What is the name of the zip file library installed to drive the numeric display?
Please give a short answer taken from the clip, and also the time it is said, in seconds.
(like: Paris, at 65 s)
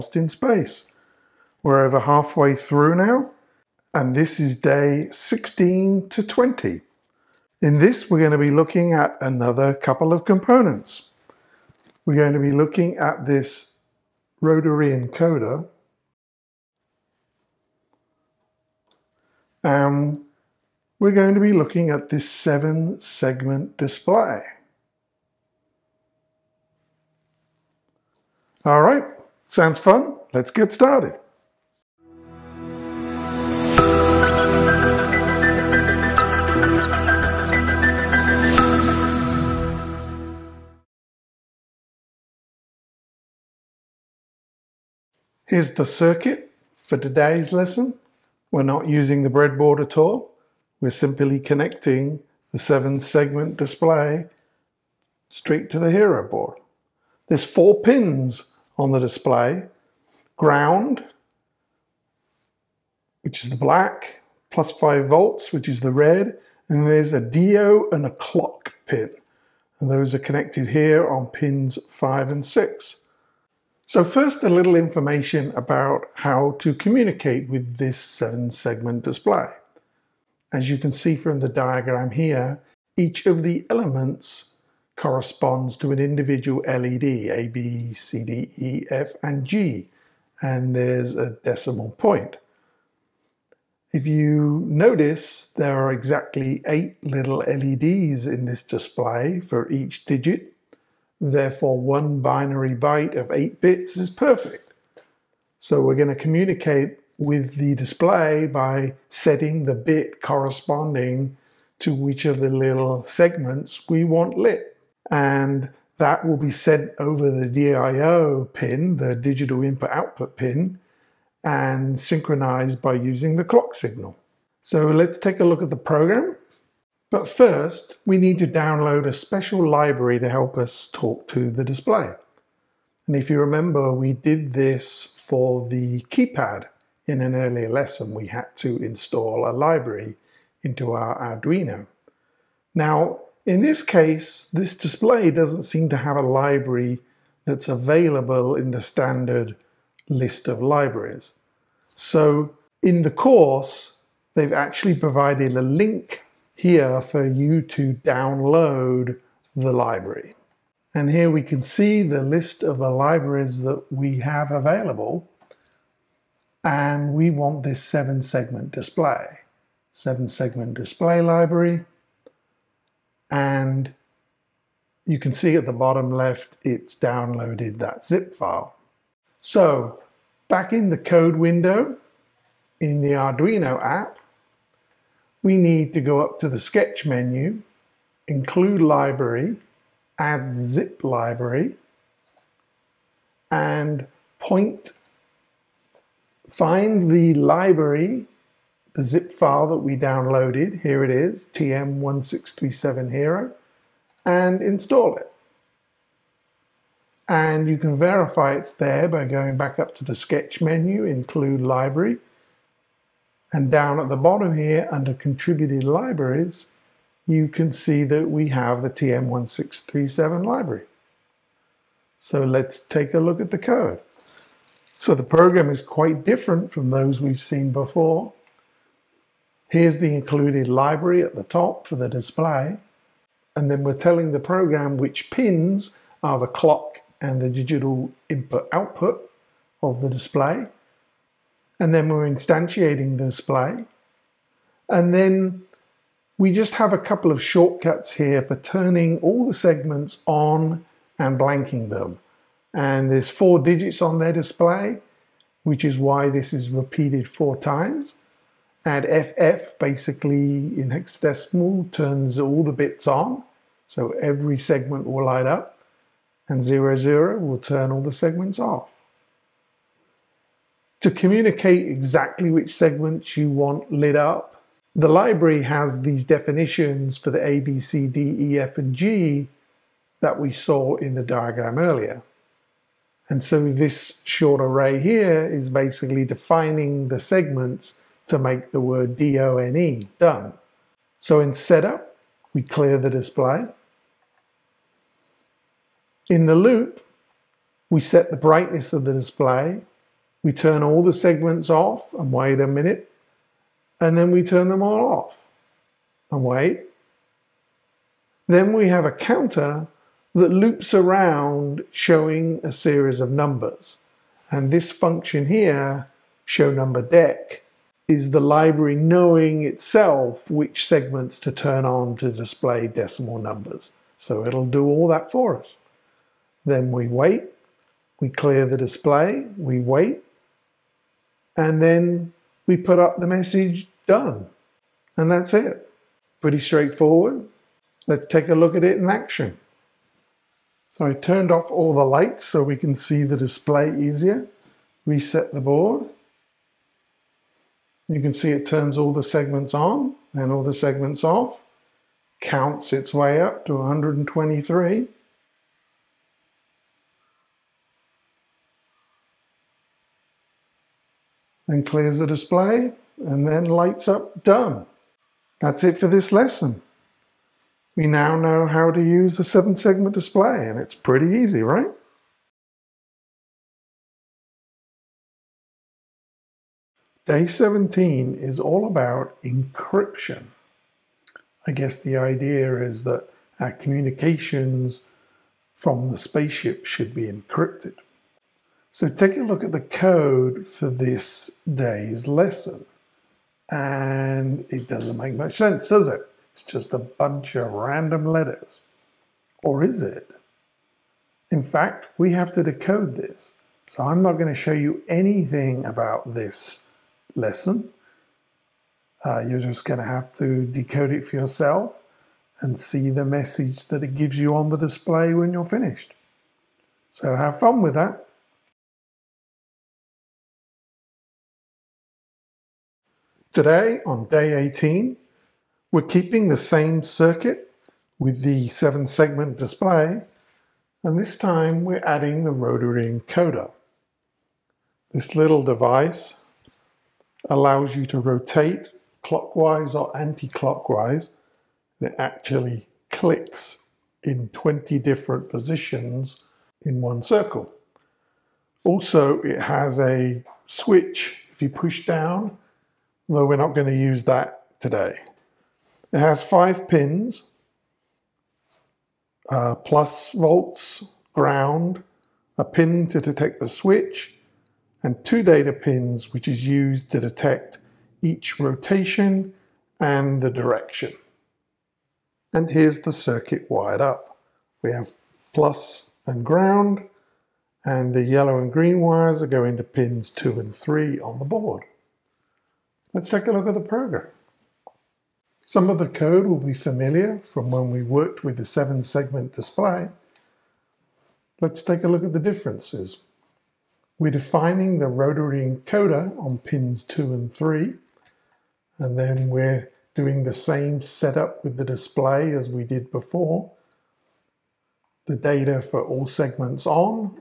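TM1637 Hero, at 201 s.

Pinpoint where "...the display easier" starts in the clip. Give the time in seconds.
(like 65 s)
343 s.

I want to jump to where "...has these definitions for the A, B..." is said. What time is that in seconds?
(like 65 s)
275 s.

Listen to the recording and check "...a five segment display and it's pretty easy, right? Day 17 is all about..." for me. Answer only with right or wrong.
wrong.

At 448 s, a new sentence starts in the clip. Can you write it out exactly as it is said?
Also, it has a switch if you push down, though we're not going to use that today.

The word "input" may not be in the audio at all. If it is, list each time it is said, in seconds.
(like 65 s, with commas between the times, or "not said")
119 s, 238 s.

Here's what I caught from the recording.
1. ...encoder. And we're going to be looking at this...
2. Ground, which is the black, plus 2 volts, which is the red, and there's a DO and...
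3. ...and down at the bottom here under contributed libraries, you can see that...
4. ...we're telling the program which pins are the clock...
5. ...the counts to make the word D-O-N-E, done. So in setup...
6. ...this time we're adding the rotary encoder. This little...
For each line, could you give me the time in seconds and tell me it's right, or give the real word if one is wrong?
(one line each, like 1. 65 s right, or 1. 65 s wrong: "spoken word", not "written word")
1. 14 s right
2. 60 s wrong: "5", not "2"
3. 213 s right
4. 233 s right
5. 287 s wrong: "segments", not "counts"
6. 431 s right.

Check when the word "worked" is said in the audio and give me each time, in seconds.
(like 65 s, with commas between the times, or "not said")
488 s.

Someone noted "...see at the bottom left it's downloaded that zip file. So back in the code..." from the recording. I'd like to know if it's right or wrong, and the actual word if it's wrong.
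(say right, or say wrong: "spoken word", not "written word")
right.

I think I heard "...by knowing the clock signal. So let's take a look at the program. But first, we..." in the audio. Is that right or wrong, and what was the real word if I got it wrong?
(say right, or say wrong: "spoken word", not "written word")
wrong: "using", not "knowing".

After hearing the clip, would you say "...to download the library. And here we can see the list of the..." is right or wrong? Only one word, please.
right.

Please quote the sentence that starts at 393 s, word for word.
And it doesn't make much sense, does it?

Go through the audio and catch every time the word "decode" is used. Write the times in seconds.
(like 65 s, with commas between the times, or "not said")
402 s, 410 s.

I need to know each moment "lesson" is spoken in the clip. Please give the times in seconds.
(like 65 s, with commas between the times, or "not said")
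47 s, 137 s, 366 s, 392 s, 407 s.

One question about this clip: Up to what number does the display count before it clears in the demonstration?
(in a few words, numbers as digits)
123.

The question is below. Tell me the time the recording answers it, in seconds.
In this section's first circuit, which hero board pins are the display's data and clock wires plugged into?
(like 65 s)
71 s.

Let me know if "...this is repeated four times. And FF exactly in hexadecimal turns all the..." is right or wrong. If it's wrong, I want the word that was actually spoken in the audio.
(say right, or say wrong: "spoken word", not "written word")
wrong: "basically", not "exactly".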